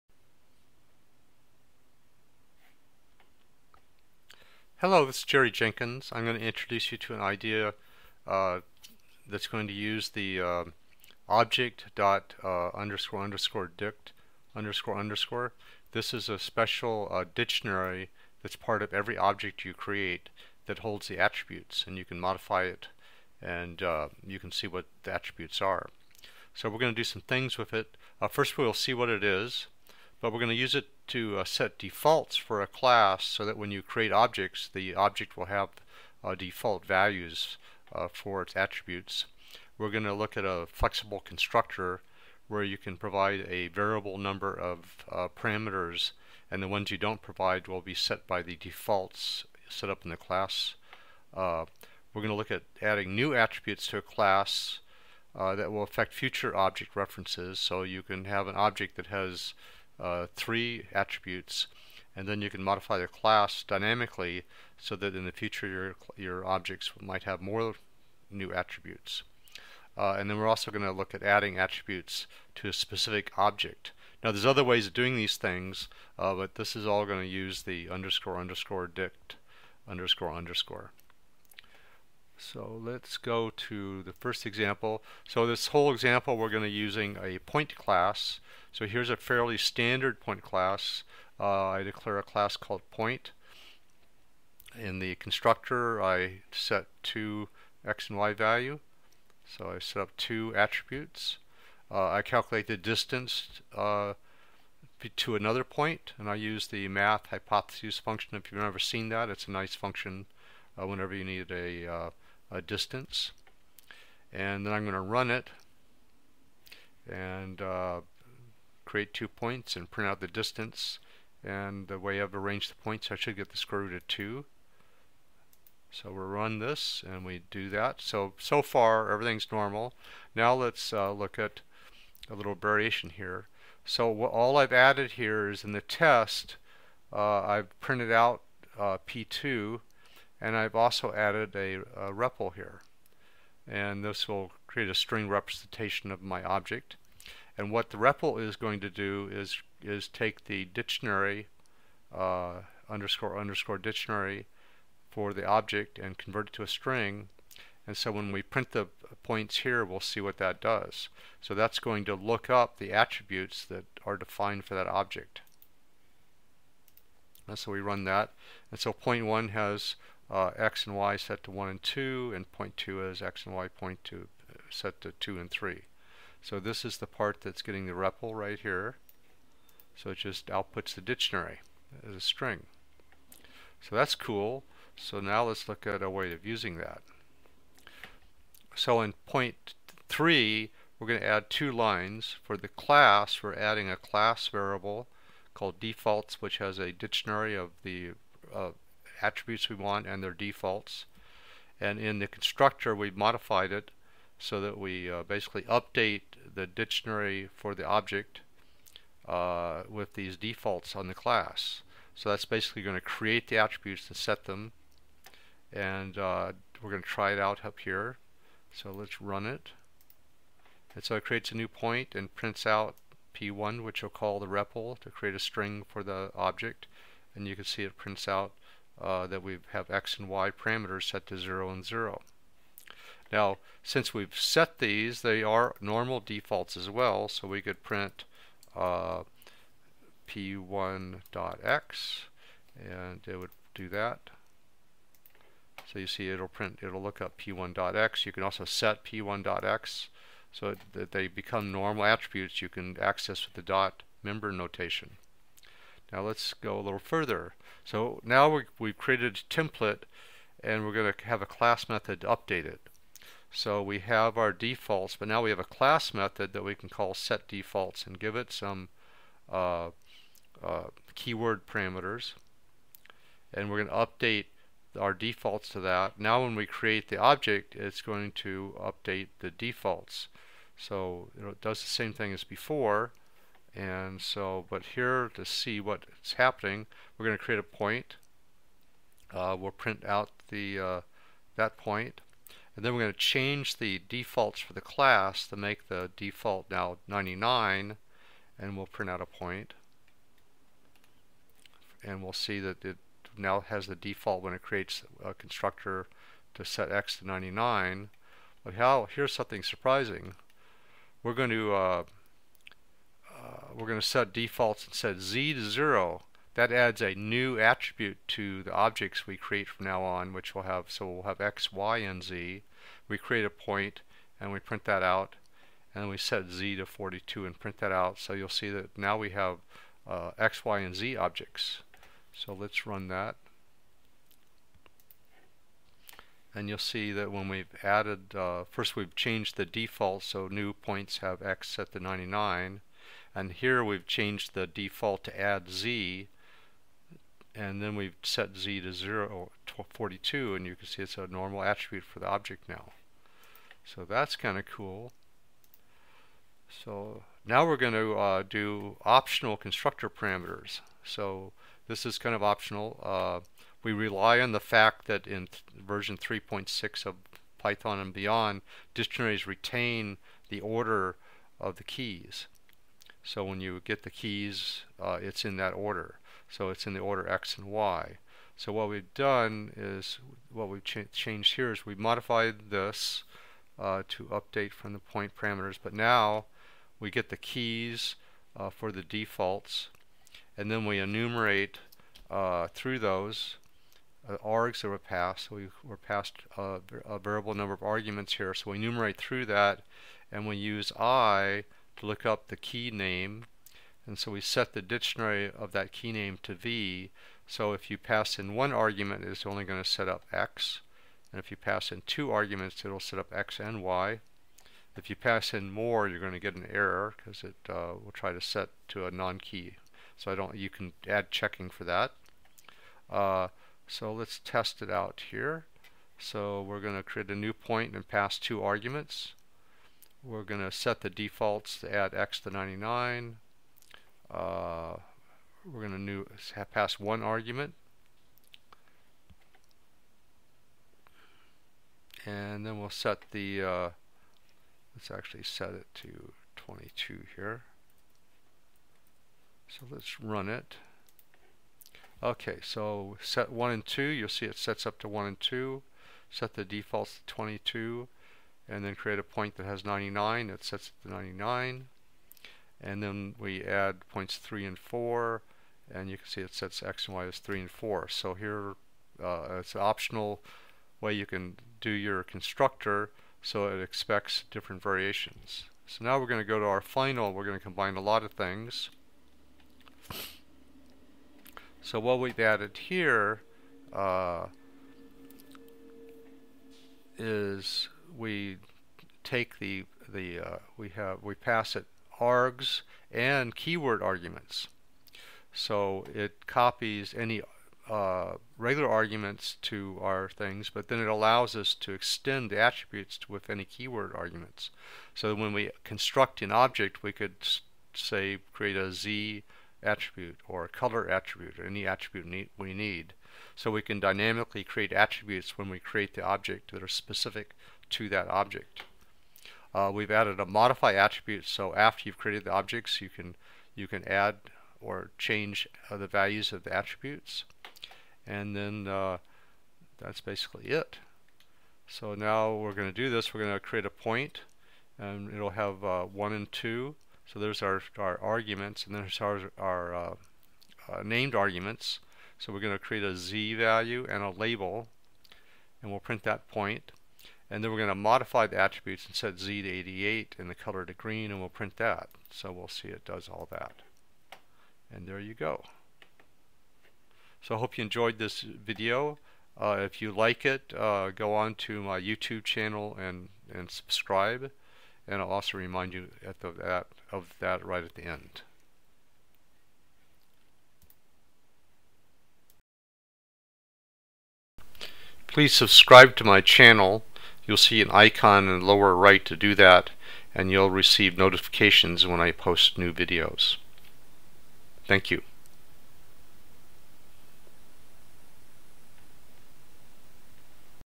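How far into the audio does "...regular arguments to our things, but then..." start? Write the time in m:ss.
8:18.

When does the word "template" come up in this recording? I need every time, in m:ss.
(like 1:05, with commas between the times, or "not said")
4:19.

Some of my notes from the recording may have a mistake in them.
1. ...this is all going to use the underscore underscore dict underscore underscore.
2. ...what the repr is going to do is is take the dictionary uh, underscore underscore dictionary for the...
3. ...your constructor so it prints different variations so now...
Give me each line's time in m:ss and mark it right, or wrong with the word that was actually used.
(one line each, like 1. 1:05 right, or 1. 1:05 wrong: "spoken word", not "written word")
1. 1:16 right
2. 2:27 right
3. 7:51 wrong: "expects", not "prints".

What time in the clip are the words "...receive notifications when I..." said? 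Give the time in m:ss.
9:40.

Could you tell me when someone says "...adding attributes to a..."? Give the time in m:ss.
1:11.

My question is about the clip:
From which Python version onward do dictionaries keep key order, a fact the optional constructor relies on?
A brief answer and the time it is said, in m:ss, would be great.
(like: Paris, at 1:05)
3.6, at 6:06.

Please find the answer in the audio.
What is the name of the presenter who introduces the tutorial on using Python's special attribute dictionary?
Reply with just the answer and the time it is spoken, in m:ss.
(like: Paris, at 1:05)
Gerry Jenkins, at 0:05.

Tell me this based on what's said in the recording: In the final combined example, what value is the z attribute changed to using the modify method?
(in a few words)
88.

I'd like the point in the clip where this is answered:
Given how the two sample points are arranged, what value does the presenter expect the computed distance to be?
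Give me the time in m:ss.
2:03.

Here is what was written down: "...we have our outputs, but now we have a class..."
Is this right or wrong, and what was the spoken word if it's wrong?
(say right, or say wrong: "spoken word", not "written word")
wrong: "defaults", not "outputs".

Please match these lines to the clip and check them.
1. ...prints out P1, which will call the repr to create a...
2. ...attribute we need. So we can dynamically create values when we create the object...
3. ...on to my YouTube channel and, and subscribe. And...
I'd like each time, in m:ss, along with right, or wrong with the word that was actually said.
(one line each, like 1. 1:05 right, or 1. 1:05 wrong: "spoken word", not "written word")
1. 3:42 right
2. 8:31 wrong: "attributes", not "values"
3. 9:21 right.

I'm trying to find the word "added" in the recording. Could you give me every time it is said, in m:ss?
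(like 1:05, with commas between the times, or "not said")
2:14, 2:21, 5:37, 8:02, 8:40.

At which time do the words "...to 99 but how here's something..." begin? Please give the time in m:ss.
5:07.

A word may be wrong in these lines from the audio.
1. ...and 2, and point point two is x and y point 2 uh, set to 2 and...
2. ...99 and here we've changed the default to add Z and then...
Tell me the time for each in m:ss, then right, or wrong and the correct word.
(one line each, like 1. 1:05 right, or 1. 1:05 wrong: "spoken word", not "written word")
1. 2:51 right
2. 5:42 right.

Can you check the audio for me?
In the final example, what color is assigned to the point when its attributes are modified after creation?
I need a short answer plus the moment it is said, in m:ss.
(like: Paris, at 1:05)
green, at 9:10.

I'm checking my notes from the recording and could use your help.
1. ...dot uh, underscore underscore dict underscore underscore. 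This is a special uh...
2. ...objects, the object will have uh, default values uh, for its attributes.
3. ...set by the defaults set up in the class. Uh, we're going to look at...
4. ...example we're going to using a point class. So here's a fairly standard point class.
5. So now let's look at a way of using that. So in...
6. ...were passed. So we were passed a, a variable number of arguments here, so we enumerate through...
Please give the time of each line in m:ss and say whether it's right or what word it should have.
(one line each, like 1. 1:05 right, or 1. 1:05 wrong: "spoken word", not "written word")
1. 0:11 right
2. 0:34 right
3. 0:47 right
4. 1:25 right
5. 3:04 right
6. 6:34 right.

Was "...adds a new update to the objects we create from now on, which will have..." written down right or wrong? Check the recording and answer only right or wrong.
wrong.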